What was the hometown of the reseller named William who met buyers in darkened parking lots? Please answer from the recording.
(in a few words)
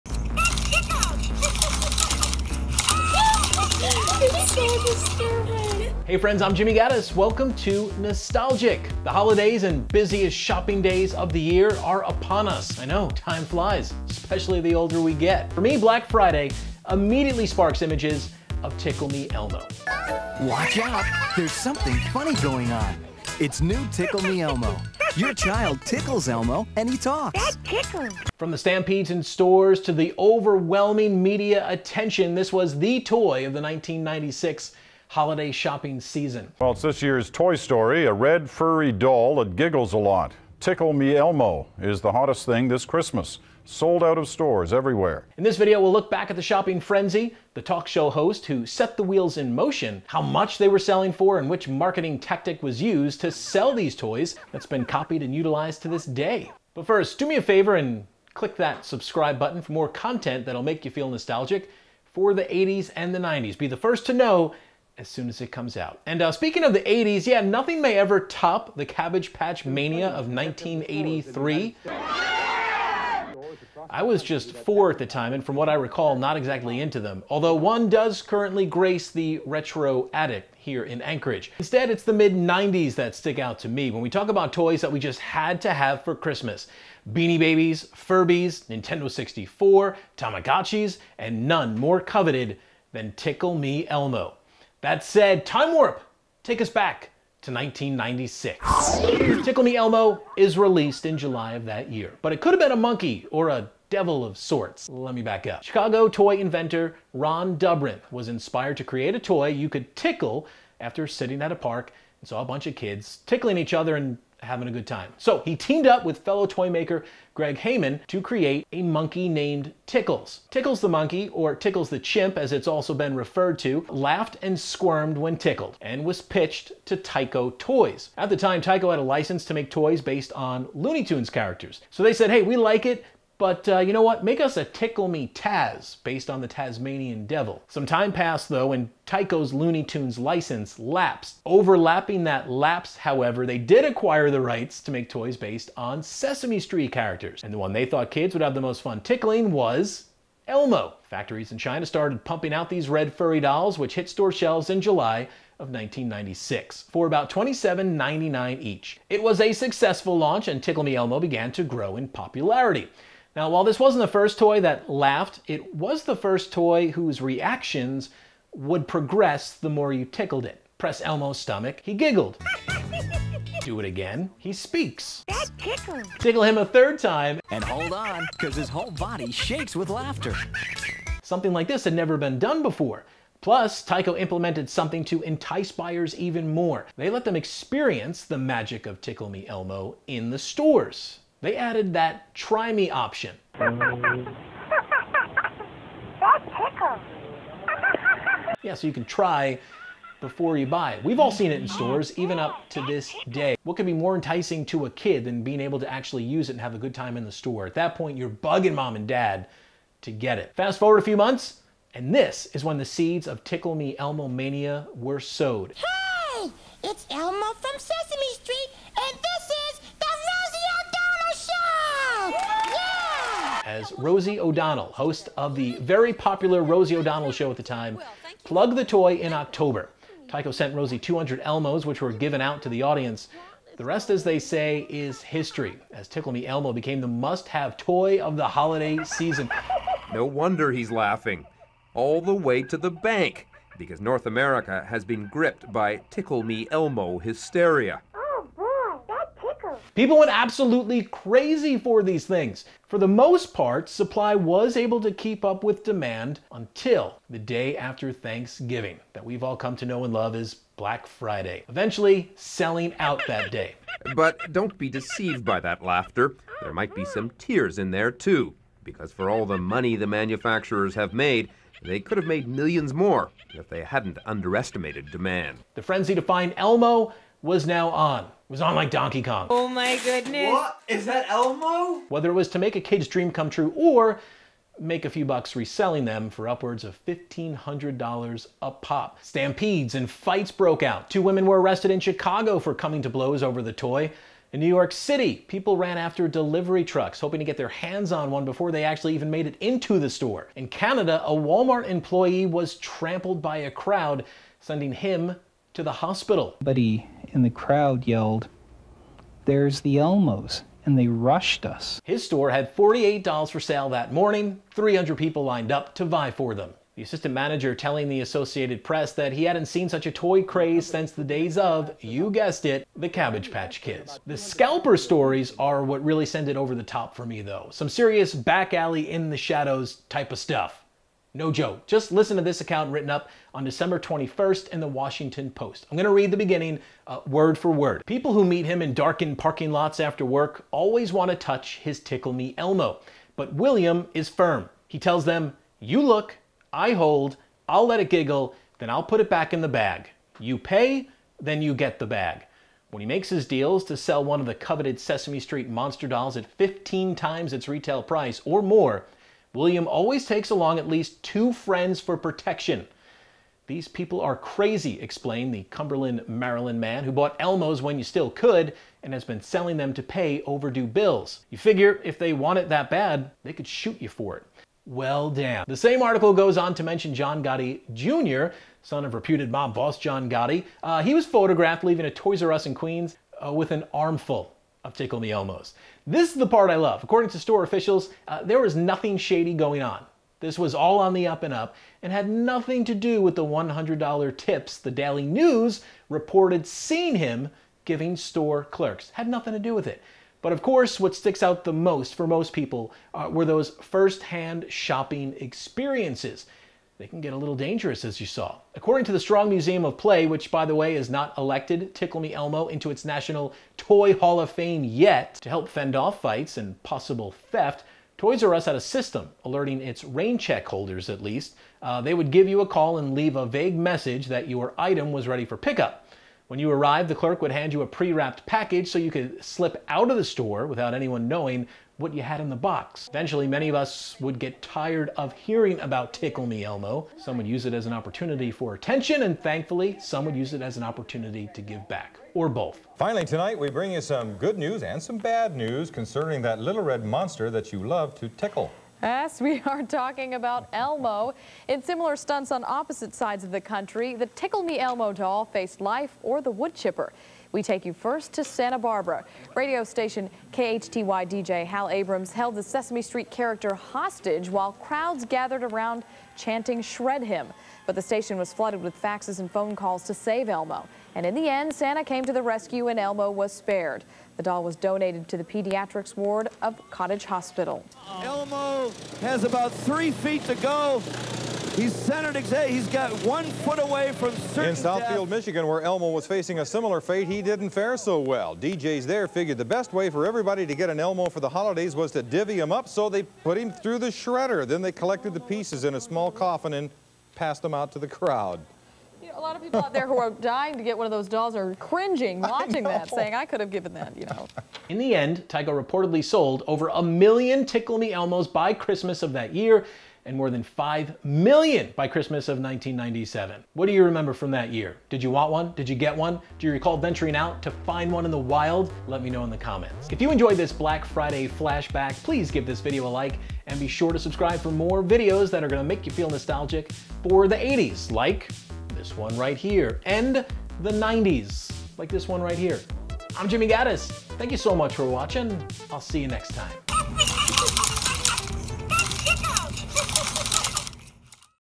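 Cumberland, Maryland.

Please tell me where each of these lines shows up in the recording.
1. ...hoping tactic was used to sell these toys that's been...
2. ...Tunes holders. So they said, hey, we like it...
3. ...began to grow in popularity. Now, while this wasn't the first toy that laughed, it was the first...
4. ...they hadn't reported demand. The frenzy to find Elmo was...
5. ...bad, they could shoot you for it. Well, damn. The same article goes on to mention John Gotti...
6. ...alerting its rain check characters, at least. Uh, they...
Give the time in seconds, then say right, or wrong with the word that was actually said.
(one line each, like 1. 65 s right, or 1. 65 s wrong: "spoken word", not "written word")
1. 51 s wrong: "marketing", not "hoping"
2. 131 s wrong: "characters", not "holders"
3. 161 s right
4. 273 s wrong: "underestimated", not "reported"
5. 372 s right
6. 419 s wrong: "holders", not "characters".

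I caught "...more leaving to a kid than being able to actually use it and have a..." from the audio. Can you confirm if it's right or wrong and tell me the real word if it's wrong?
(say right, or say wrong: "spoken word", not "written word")
wrong: "enticing", not "leaving".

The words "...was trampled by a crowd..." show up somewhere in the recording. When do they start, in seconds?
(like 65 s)
302 s.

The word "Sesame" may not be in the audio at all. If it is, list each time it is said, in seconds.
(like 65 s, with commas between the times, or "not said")
146 s, 217 s, 354 s, 462 s.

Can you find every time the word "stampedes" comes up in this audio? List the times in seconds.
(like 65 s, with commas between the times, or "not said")
28 s, 289 s.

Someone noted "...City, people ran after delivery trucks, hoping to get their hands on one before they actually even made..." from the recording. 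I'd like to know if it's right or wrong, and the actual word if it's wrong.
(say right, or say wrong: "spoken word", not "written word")
right.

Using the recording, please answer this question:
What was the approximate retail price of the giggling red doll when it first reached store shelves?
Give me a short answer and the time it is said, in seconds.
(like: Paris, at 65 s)
$27.99, at 157 s.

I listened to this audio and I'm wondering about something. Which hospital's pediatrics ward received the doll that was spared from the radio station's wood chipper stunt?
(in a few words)
Cottage Hospital.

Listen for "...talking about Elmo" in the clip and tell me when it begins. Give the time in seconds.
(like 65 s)
449 s.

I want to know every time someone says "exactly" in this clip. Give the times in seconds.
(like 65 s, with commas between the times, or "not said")
76 s, 482 s.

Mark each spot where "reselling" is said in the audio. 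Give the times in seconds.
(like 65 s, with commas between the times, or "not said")
285 s.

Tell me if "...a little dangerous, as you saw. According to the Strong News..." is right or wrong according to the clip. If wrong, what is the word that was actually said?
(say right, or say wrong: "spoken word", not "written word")
wrong: "Museum", not "News".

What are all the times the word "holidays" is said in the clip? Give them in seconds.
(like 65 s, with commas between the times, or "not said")
9 s, 35 s, 238 s, 491 s.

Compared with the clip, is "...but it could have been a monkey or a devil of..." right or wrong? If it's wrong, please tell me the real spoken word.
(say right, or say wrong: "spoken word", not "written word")
right.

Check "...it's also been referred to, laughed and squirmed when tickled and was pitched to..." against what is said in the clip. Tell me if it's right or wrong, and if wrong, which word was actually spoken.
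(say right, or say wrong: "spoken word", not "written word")
right.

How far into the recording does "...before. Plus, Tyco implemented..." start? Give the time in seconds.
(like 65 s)
182 s.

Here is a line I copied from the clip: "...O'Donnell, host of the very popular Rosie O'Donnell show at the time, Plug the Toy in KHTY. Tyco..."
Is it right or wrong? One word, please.
wrong.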